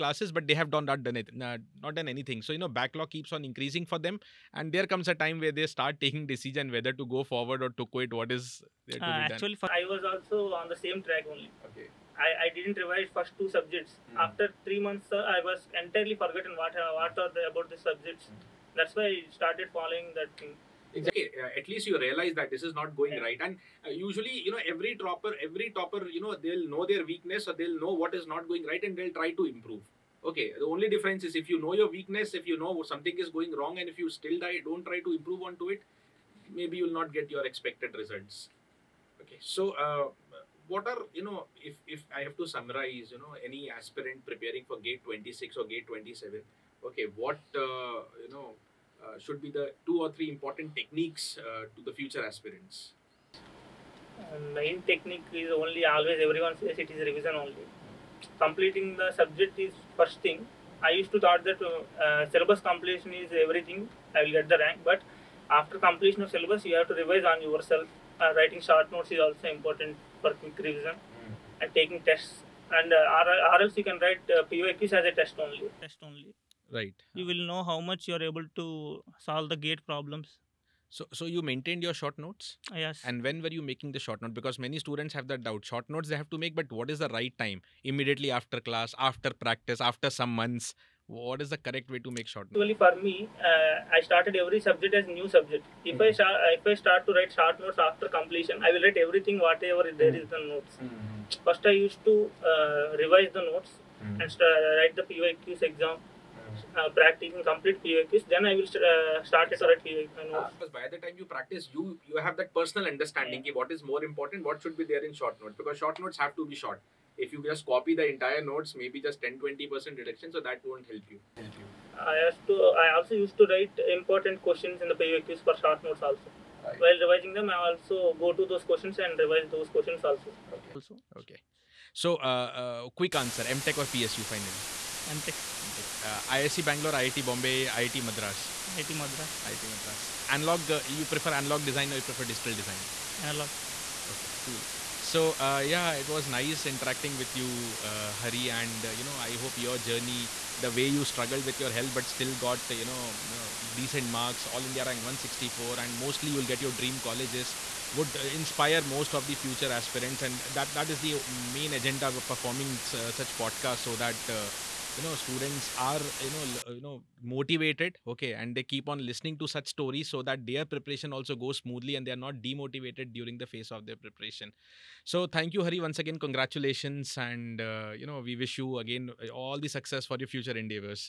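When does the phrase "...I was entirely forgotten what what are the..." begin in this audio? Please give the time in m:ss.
0:15.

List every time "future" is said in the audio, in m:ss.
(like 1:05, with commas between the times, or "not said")
0:51, 2:39, 3:00.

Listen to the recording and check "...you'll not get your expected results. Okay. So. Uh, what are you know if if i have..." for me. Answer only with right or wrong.
right.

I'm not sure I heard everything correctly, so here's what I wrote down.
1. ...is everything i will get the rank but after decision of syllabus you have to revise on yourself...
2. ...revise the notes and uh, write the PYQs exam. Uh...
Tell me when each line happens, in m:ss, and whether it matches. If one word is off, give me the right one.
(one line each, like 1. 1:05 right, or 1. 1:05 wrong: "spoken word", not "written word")
1. 1:03 wrong: "completion", not "decision"
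2. 1:43 right.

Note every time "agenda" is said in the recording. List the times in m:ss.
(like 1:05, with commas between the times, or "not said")
2:41.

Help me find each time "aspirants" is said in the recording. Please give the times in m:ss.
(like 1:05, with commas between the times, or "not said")
0:43, 0:52, 2:39.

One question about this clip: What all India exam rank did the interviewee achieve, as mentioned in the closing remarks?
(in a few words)
164.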